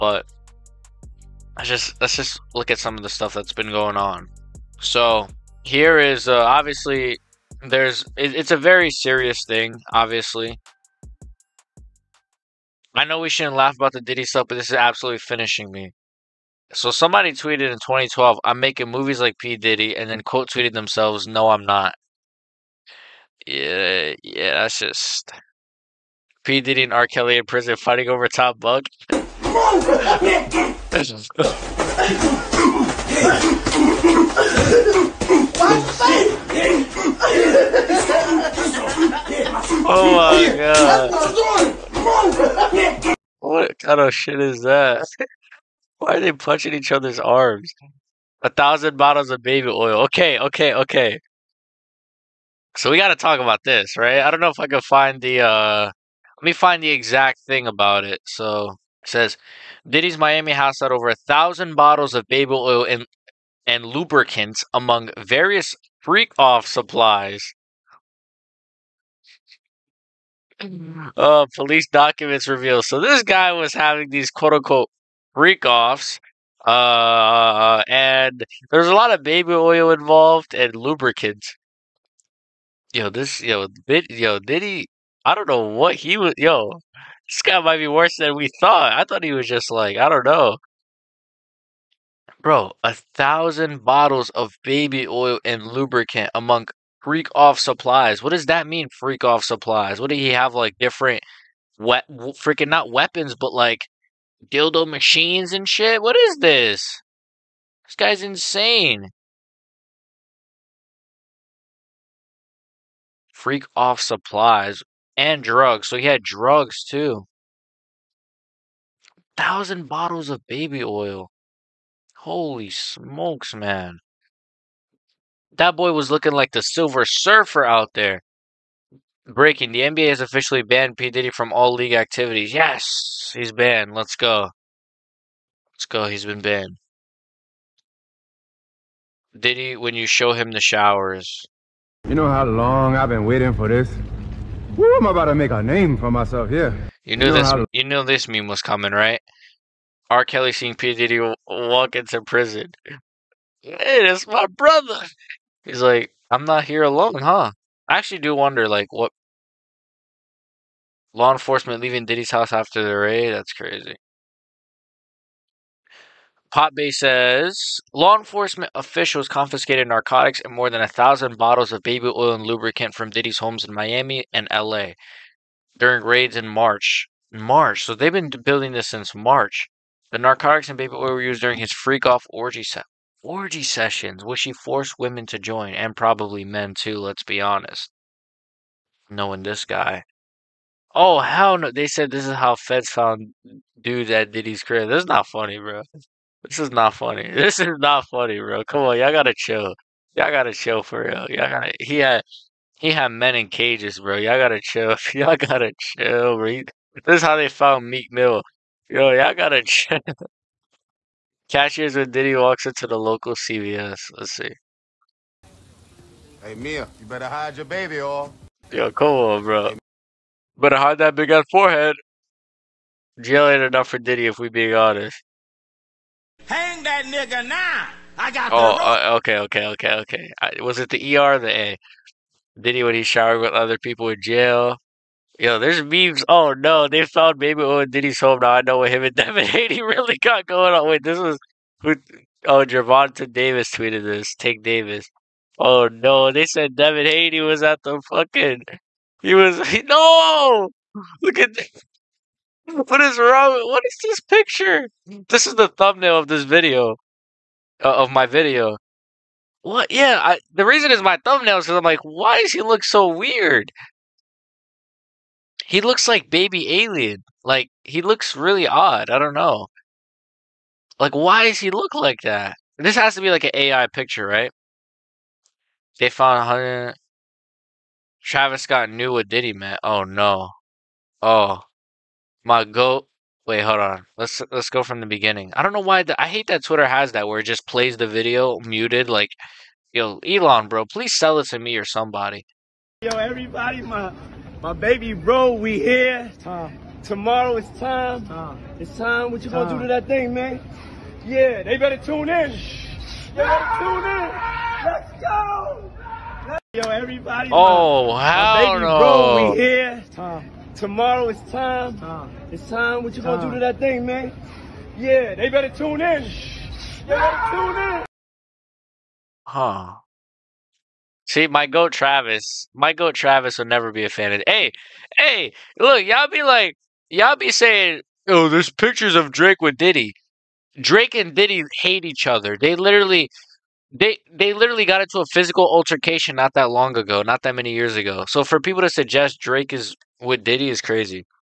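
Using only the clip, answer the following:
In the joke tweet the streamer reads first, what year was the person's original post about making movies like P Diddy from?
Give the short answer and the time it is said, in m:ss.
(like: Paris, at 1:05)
2012, at 0:17.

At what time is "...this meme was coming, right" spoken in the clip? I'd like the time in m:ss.
2:28.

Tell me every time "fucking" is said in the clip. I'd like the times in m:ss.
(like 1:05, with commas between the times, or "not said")
4:08.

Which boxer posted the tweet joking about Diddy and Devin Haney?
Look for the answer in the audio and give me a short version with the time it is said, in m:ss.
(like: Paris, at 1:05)
Gervonta Davis, at 4:02.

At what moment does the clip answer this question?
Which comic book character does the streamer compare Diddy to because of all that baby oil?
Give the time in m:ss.
2:06.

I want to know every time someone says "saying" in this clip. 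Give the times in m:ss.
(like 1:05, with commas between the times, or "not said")
5:27.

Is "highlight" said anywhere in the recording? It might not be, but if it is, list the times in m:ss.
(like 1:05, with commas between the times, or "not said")
not said.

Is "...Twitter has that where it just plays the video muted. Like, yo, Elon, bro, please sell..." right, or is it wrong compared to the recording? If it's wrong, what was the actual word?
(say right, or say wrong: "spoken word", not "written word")
right.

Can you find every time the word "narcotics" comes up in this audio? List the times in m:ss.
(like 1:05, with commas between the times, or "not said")
2:49, 3:00.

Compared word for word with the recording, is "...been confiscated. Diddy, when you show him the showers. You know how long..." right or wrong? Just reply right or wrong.
wrong.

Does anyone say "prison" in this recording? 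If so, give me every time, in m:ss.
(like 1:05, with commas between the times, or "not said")
0:27, 2:32.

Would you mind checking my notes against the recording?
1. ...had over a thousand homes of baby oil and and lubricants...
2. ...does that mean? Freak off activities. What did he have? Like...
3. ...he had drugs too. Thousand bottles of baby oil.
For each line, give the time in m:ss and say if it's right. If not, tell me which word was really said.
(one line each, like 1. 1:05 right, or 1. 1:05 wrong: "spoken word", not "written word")
1. 1:00 wrong: "bottles", not "homes"
2. 1:38 wrong: "supplies", not "activities"
3. 1:55 right.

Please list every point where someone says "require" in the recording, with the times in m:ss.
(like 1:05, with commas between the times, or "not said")
not said.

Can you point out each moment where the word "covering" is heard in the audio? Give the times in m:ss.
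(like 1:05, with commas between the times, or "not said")
not said.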